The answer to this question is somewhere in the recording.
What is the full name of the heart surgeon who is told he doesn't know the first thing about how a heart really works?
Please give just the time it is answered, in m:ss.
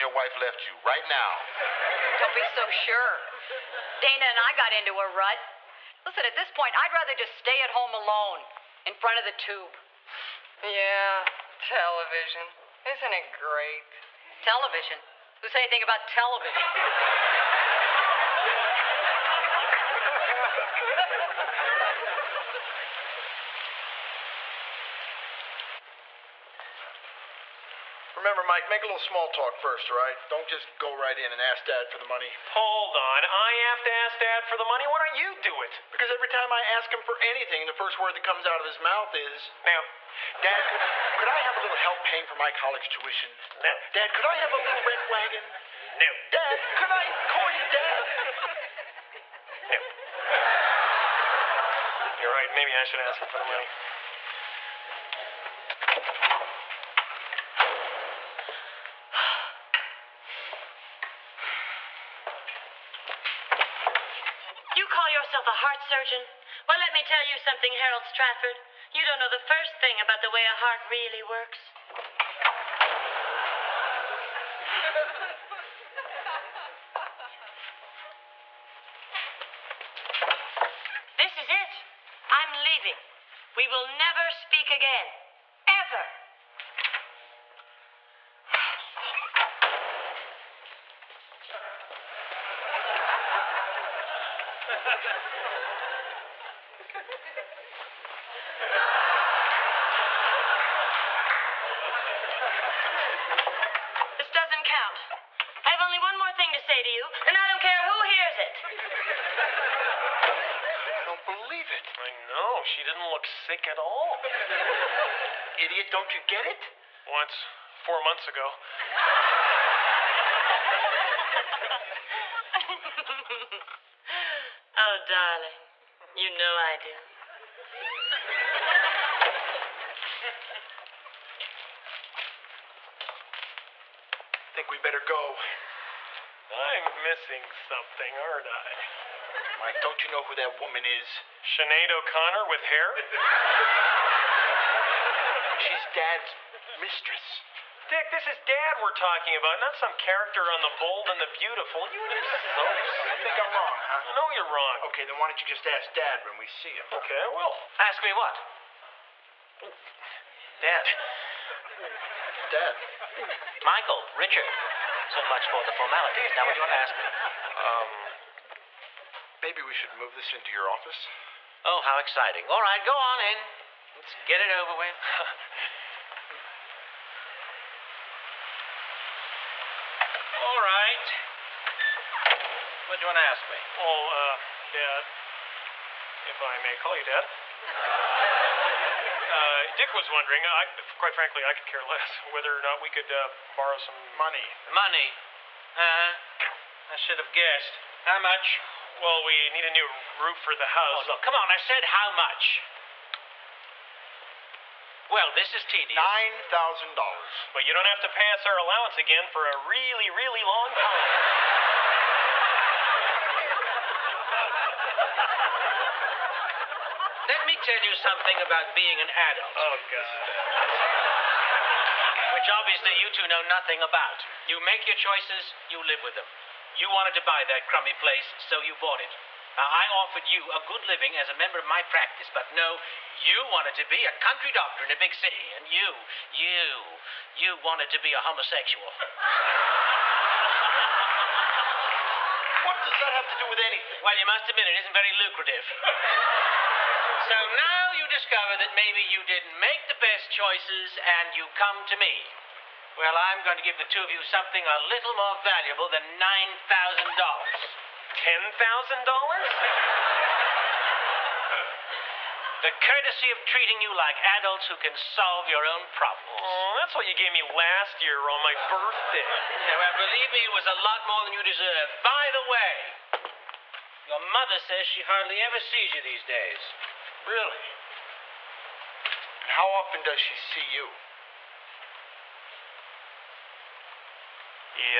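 1:07.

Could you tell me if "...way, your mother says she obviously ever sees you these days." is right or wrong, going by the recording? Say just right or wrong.
wrong.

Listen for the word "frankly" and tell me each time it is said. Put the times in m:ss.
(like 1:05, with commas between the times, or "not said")
3:11.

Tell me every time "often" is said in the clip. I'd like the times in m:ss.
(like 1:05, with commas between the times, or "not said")
4:39.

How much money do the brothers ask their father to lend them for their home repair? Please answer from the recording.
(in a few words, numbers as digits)
$9,000.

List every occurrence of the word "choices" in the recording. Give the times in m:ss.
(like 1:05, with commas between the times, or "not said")
3:44, 4:10.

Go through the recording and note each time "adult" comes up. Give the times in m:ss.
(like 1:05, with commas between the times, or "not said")
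3:39, 4:24.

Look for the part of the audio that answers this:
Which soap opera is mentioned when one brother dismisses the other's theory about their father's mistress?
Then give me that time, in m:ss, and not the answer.
2:30.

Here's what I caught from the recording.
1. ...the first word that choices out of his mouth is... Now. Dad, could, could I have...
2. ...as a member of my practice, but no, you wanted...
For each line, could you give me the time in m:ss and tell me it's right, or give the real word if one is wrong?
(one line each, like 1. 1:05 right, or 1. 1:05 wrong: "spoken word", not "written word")
1. 0:37 wrong: "comes", not "choices"
2. 3:51 right.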